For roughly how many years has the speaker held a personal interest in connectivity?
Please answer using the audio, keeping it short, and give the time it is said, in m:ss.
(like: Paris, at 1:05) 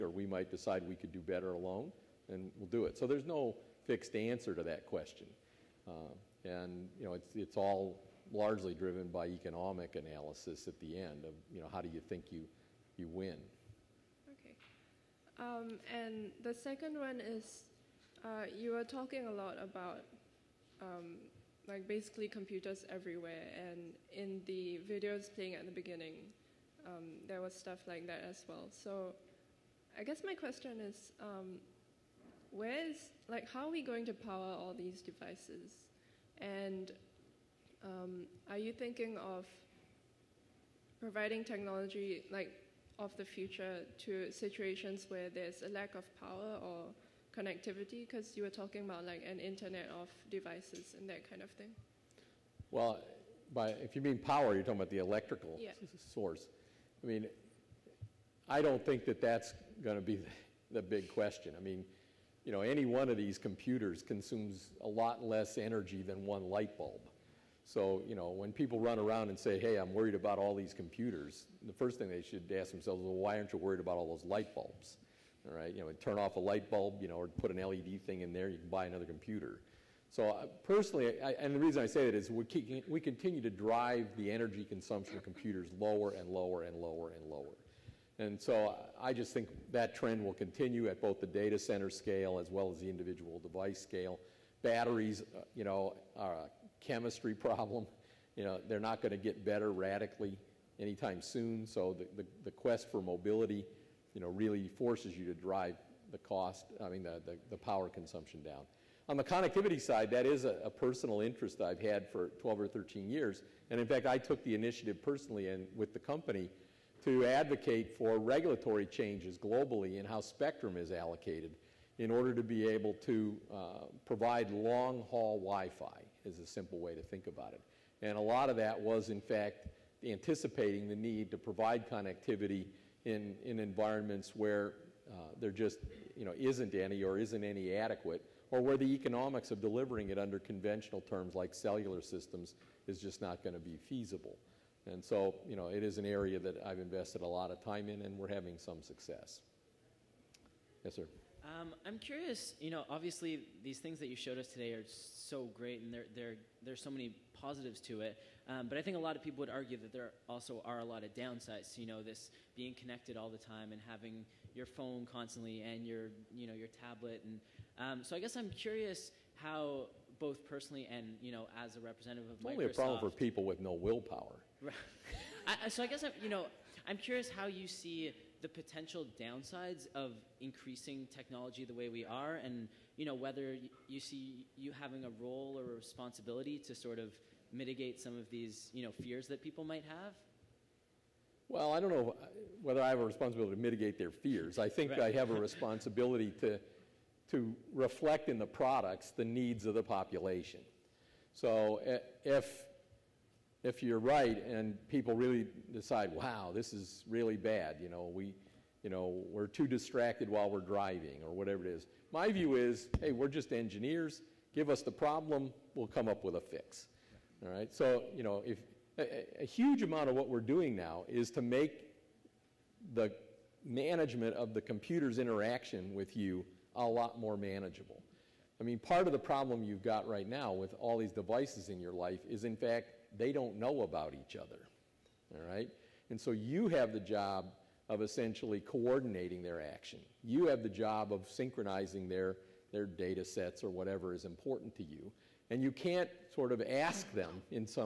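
12 or 13, at 1:52.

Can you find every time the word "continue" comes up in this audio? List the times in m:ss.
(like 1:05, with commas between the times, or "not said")
1:22, 1:30.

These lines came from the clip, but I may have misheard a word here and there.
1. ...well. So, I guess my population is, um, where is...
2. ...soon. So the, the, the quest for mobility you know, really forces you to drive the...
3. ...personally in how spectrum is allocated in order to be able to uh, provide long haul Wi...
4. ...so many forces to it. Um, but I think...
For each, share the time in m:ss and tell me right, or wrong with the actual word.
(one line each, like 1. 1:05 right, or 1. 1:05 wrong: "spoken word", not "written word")
1. 0:28 wrong: "question", not "population"
2. 1:41 right
3. 1:59 wrong: "globally", not "personally"
4. 2:36 wrong: "positives", not "forces".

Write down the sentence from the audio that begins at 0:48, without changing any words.
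Because you were talking about like an internet of devices and that kind of thing.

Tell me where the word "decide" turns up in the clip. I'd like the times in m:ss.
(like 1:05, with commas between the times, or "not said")
0:00, 3:25.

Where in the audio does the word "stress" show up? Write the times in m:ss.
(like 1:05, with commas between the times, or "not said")
not said.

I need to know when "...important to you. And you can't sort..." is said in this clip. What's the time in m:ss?
4:04.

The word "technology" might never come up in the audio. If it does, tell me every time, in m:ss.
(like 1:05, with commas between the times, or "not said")
0:41, 3:01.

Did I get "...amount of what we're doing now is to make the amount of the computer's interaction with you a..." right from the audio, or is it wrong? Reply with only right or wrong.
wrong.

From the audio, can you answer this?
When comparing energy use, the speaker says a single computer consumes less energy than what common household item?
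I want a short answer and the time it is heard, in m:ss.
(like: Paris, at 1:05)
One light bulb, at 1:06.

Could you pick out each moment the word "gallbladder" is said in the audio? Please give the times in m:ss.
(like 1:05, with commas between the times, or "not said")
not said.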